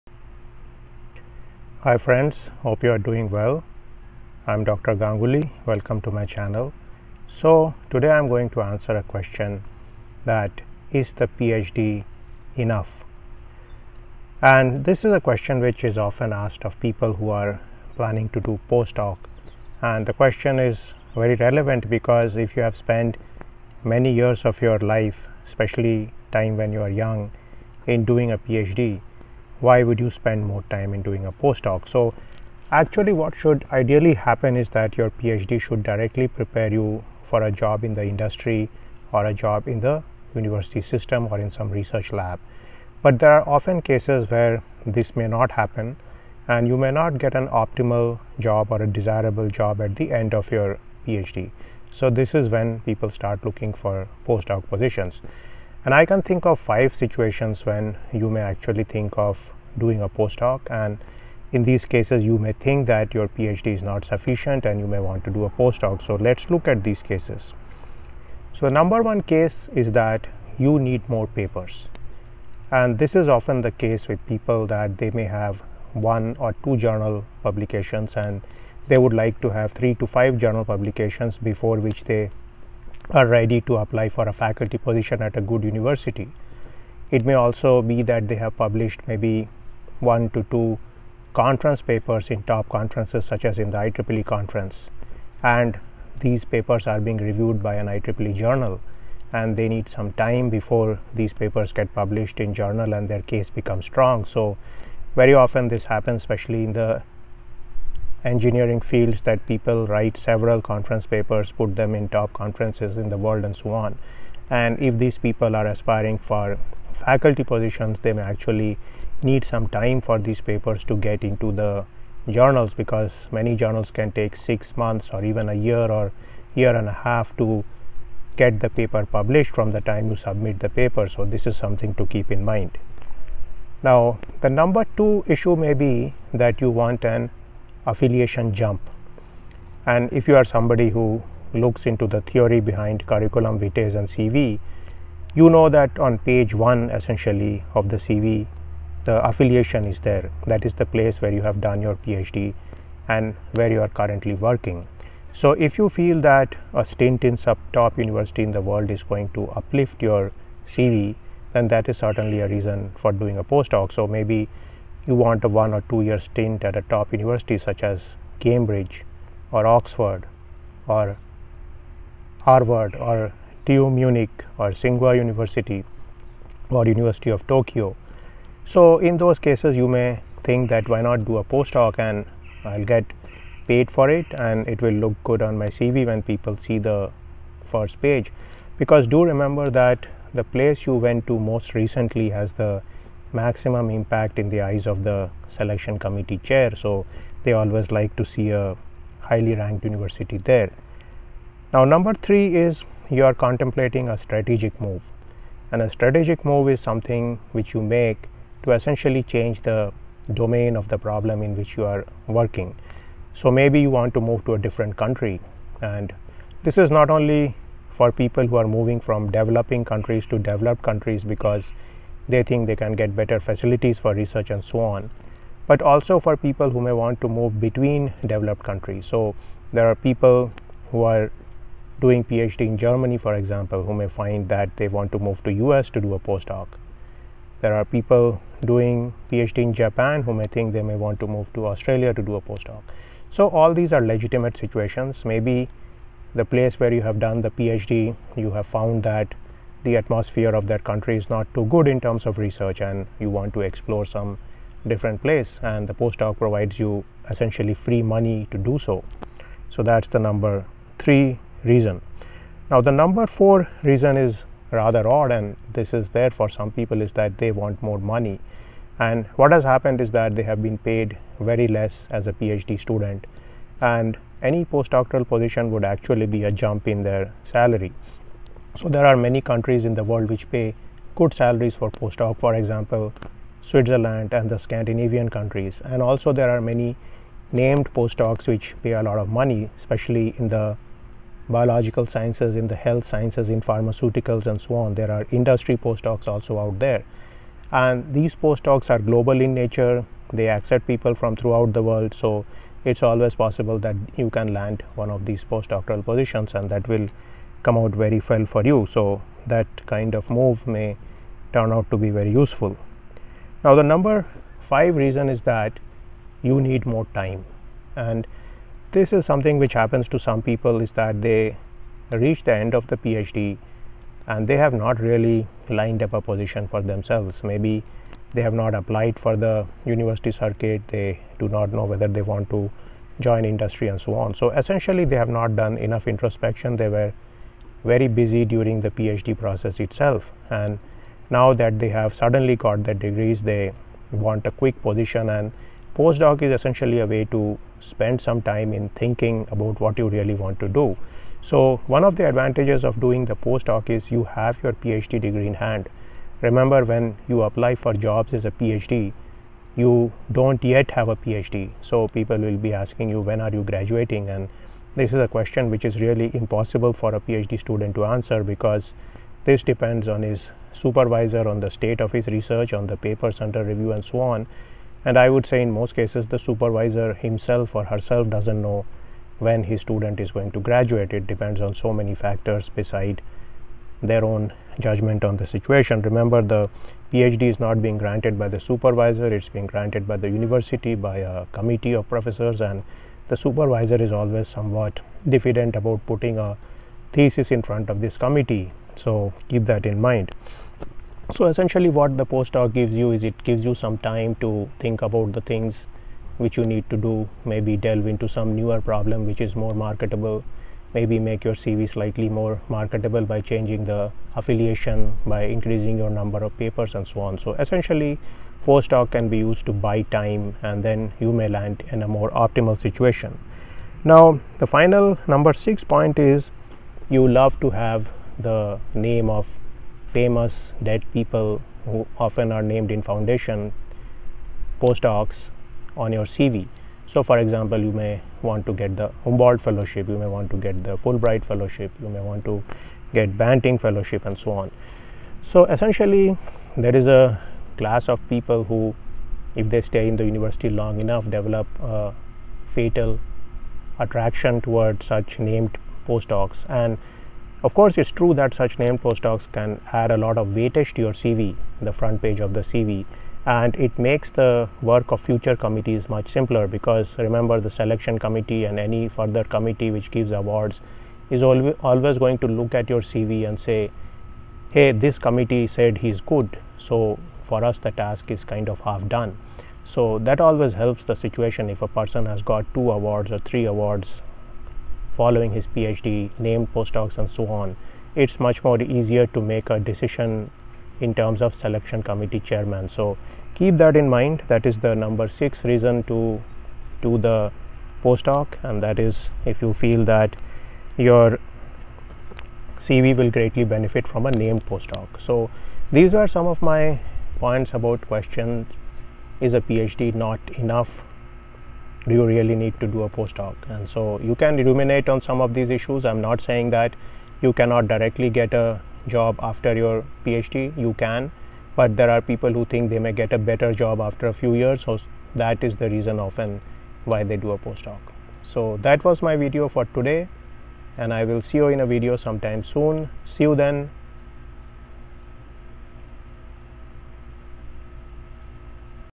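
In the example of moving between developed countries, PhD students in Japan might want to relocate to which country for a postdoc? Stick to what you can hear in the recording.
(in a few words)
Australia.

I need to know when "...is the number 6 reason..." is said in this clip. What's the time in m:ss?
8:14.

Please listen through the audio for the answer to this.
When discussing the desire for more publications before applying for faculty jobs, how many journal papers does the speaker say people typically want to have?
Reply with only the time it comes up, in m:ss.
1:19.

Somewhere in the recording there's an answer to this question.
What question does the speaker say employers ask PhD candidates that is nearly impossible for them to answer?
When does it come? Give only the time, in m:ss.
6:03.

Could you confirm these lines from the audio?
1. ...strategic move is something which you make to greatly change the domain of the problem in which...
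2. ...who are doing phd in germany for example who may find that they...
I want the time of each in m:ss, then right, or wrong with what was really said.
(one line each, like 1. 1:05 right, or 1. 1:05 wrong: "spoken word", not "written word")
1. 3:25 wrong: "essentially", not "greatly"
2. 3:50 right.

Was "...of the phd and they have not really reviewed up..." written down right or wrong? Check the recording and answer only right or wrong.
wrong.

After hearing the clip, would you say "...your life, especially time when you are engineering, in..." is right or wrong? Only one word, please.
wrong.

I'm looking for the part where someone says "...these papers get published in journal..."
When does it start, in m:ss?
1:41.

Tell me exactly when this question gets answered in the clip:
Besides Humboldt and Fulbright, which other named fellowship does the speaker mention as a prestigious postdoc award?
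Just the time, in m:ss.
7:23.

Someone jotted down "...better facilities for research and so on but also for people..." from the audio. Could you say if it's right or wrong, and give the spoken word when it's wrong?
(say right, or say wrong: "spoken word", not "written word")
right.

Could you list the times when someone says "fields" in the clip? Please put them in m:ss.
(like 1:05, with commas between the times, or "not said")
1:48.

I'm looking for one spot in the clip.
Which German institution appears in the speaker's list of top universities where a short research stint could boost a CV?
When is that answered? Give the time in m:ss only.
2:53.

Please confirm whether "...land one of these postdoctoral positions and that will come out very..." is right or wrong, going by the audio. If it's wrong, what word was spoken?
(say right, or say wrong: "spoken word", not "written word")
right.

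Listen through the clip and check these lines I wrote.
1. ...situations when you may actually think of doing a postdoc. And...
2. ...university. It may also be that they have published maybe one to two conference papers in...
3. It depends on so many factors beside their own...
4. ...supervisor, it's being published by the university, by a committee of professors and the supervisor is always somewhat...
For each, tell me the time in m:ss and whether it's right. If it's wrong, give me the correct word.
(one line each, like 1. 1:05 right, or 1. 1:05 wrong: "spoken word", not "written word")
1. 0:56 right
2. 1:25 right
3. 6:21 right
4. 6:28 wrong: "granted", not "published".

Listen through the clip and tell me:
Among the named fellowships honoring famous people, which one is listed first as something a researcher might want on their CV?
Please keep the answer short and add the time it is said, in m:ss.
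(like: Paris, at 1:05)
Humboldt fellowship, at 7:19.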